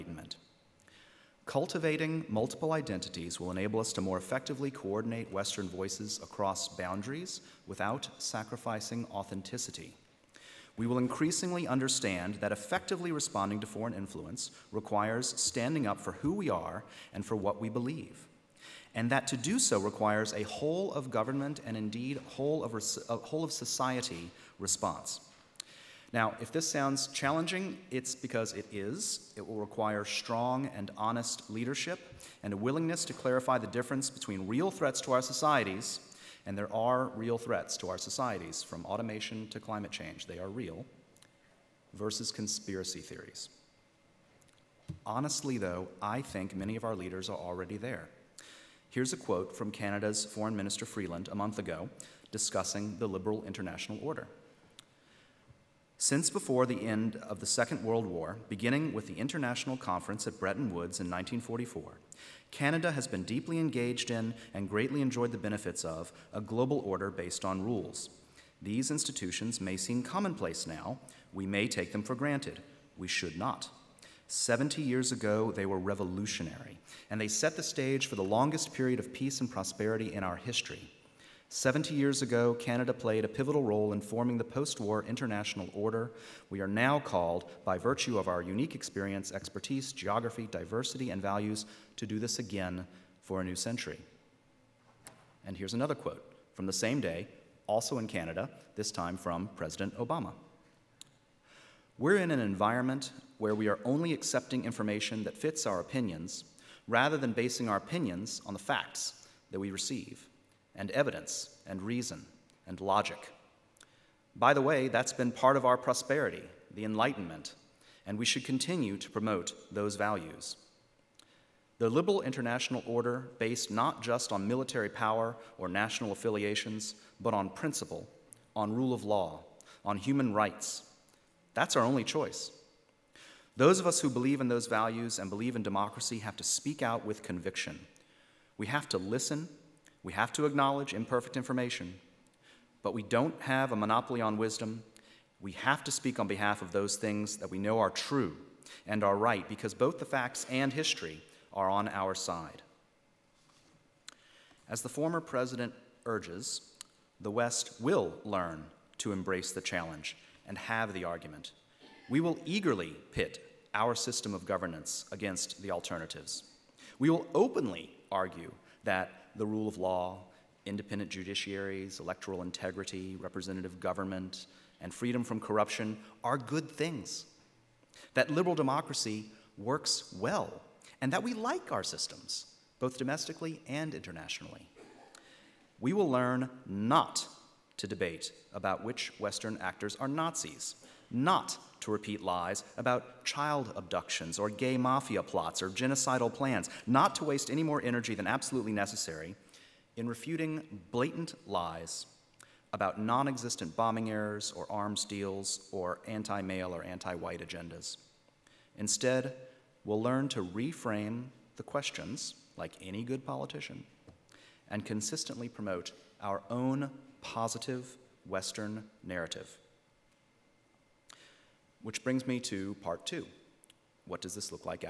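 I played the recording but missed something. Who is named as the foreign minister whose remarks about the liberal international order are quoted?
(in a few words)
Freeland.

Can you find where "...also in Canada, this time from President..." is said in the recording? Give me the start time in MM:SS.
01:37.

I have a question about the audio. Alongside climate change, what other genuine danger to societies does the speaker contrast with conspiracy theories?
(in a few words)
Automation.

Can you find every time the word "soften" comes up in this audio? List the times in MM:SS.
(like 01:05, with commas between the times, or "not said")
not said.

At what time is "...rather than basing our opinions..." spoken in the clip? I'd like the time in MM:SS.
01:46.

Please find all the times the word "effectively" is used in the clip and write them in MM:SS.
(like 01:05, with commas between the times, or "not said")
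00:04, 00:12.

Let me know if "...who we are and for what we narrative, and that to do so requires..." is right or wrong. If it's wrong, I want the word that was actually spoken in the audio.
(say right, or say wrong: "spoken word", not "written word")
wrong: "believe", not "narrative".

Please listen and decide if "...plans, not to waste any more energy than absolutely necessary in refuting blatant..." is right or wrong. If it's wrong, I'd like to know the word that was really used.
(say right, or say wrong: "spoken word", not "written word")
right.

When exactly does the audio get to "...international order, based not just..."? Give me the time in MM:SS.
02:02.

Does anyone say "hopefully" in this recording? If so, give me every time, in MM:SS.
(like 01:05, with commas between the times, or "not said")
not said.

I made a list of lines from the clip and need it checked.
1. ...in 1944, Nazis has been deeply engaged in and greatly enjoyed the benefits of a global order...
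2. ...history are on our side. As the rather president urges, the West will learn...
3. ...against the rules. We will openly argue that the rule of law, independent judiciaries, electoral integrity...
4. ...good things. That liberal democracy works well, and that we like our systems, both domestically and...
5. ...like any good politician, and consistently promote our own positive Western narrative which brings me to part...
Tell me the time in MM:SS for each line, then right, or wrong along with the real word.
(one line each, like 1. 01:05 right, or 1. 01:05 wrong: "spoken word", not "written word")
1. 01:00 wrong: "Canada", not "Nazis"
2. 02:30 wrong: "former", not "rather"
3. 02:45 wrong: "alternatives", not "rules"
4. 02:56 right
5. 03:32 right.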